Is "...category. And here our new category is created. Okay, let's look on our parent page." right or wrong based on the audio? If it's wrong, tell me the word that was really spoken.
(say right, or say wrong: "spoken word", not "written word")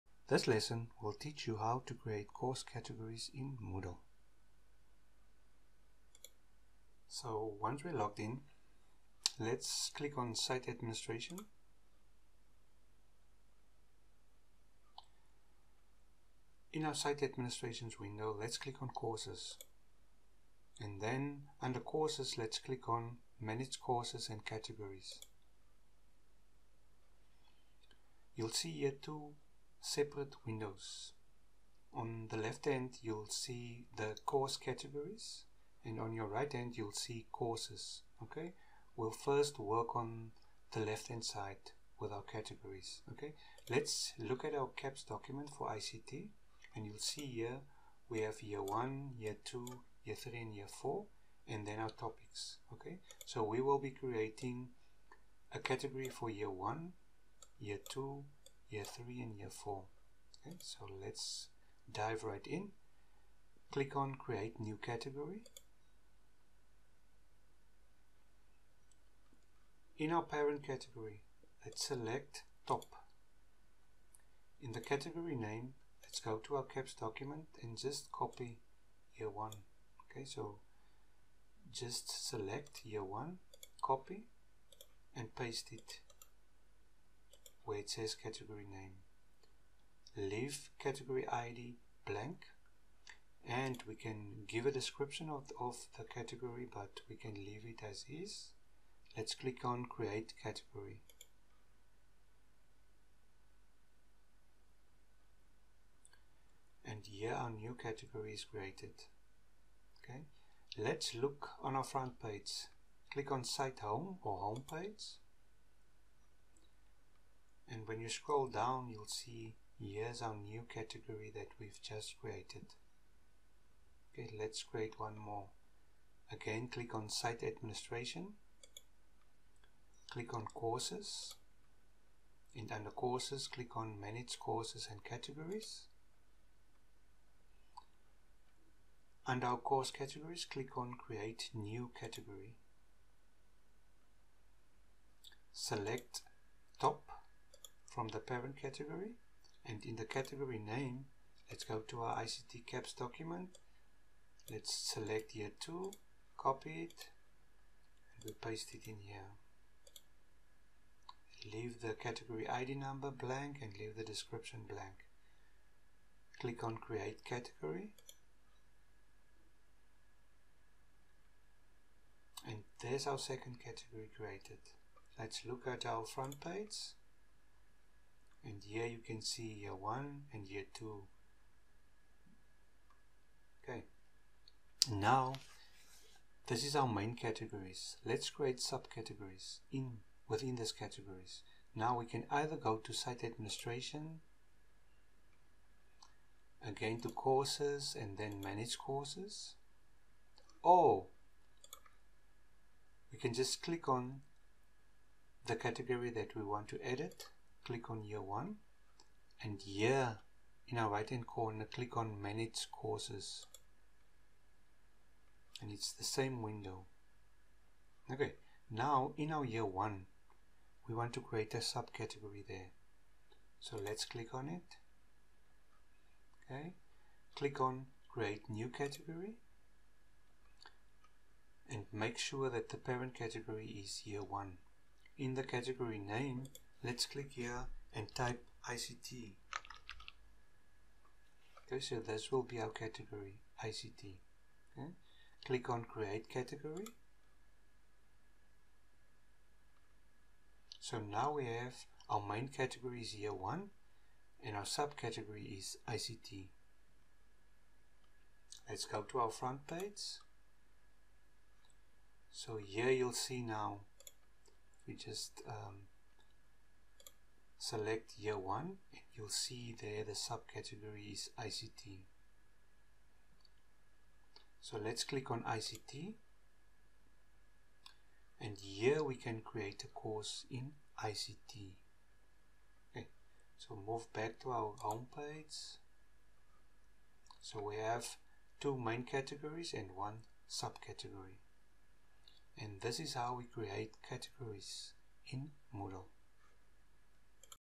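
wrong: "front", not "parent".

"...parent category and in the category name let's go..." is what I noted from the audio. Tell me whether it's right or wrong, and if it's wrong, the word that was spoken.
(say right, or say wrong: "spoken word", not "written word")
right.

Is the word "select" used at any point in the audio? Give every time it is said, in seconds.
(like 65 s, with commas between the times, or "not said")
71 s, 82 s, 145 s, 154 s, 267 s.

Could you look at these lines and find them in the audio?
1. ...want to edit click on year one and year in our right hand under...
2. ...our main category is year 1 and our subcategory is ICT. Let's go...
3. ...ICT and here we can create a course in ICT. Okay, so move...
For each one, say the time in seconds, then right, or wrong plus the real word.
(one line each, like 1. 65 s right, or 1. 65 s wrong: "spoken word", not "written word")
1. 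206 s wrong: "corner", not "under"
2. 252 s right
3. 275 s right.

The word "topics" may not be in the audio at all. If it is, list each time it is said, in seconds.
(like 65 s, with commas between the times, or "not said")
51 s.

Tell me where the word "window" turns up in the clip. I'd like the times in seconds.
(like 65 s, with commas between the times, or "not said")
17 s, 30 s, 216 s.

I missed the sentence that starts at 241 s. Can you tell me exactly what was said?
Okay, so this will be our category, ICT.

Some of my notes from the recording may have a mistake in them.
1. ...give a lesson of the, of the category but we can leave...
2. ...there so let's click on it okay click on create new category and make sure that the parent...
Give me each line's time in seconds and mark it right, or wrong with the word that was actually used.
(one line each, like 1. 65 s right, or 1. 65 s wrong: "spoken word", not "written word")
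1. 94 s wrong: "description", not "lesson"
2. 222 s right.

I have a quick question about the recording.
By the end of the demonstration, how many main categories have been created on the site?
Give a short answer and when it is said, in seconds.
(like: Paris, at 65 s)
2, at 288 s.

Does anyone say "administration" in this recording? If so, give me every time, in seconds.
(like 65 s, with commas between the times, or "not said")
10 s, 17 s, 127 s, 193 s.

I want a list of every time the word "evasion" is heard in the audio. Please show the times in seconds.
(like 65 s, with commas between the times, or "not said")
not said.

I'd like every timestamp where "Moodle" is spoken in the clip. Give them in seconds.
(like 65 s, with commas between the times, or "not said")
3 s, 295 s.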